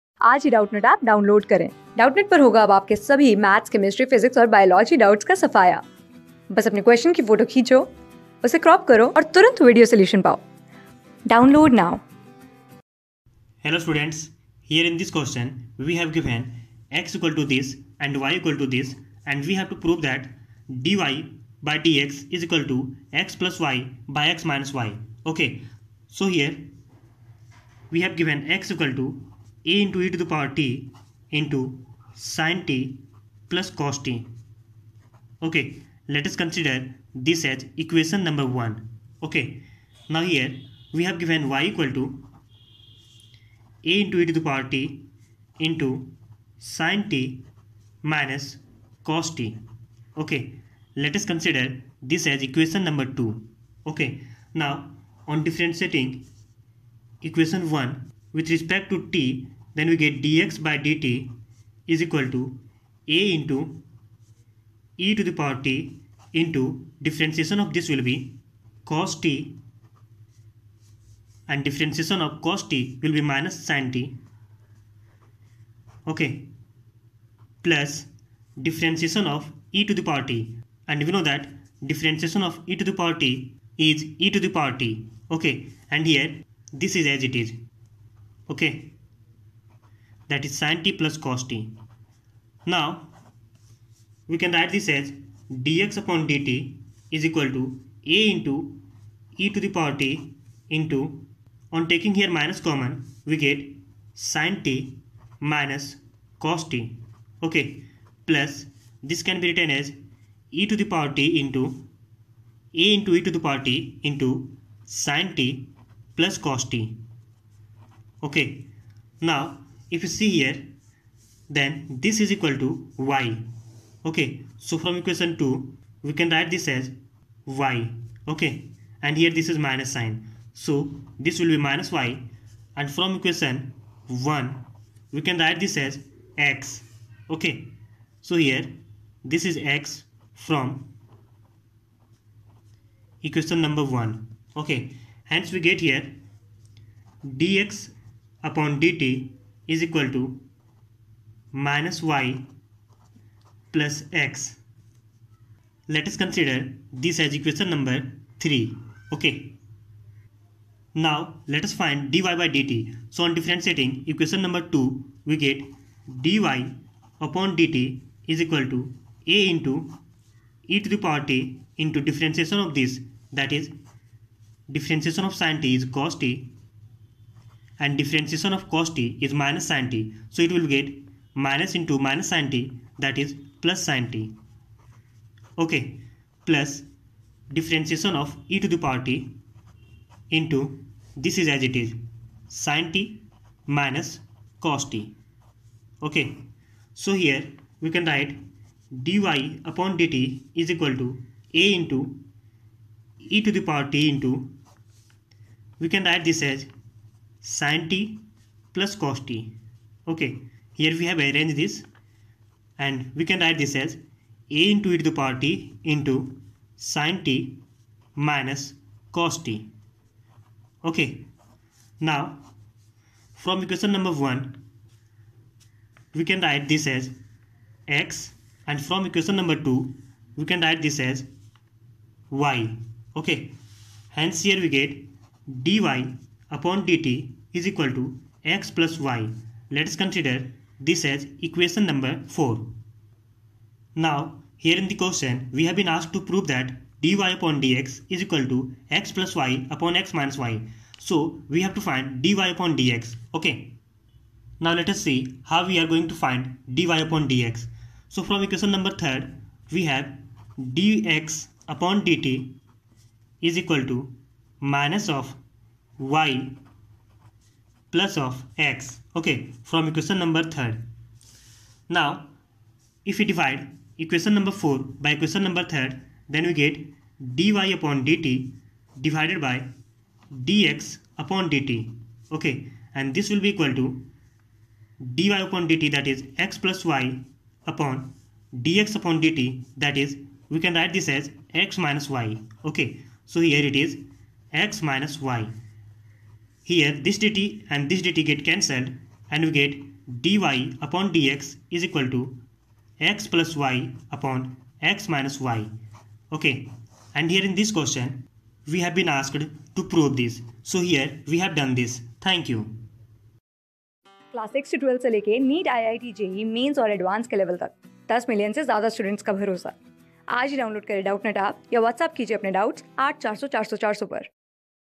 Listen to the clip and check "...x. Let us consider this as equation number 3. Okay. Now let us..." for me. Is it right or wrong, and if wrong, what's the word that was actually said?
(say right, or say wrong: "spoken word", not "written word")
right.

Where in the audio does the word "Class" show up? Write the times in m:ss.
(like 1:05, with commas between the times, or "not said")
5:14.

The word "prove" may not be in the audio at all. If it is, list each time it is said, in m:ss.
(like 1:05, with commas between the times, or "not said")
0:19, 4:06, 5:09.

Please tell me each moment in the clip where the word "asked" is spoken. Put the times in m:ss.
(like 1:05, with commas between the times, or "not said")
4:05, 5:09.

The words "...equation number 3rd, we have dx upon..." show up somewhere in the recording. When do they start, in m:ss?
4:18.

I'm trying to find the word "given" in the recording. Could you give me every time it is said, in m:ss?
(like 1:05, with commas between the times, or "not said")
0:28, 0:41.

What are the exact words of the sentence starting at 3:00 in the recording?
So it will get minus into minus sin t that is plus sin t.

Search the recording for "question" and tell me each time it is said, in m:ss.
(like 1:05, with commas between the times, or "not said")
4:04, 5:07.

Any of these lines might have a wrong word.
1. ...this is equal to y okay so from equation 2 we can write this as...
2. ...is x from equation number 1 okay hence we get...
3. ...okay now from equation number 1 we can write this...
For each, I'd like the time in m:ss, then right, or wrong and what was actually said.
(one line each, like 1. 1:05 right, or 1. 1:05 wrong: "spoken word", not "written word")
1. 2:01 right
2. 2:19 right
3. 3:40 right.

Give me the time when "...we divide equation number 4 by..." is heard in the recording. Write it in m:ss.
4:33.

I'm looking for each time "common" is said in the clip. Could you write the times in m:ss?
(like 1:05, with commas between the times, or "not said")
1:42.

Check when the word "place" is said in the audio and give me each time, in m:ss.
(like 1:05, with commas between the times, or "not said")
not said.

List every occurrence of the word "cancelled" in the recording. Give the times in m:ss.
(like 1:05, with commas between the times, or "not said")
4:58.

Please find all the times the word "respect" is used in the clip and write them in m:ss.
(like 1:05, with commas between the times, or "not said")
0:58.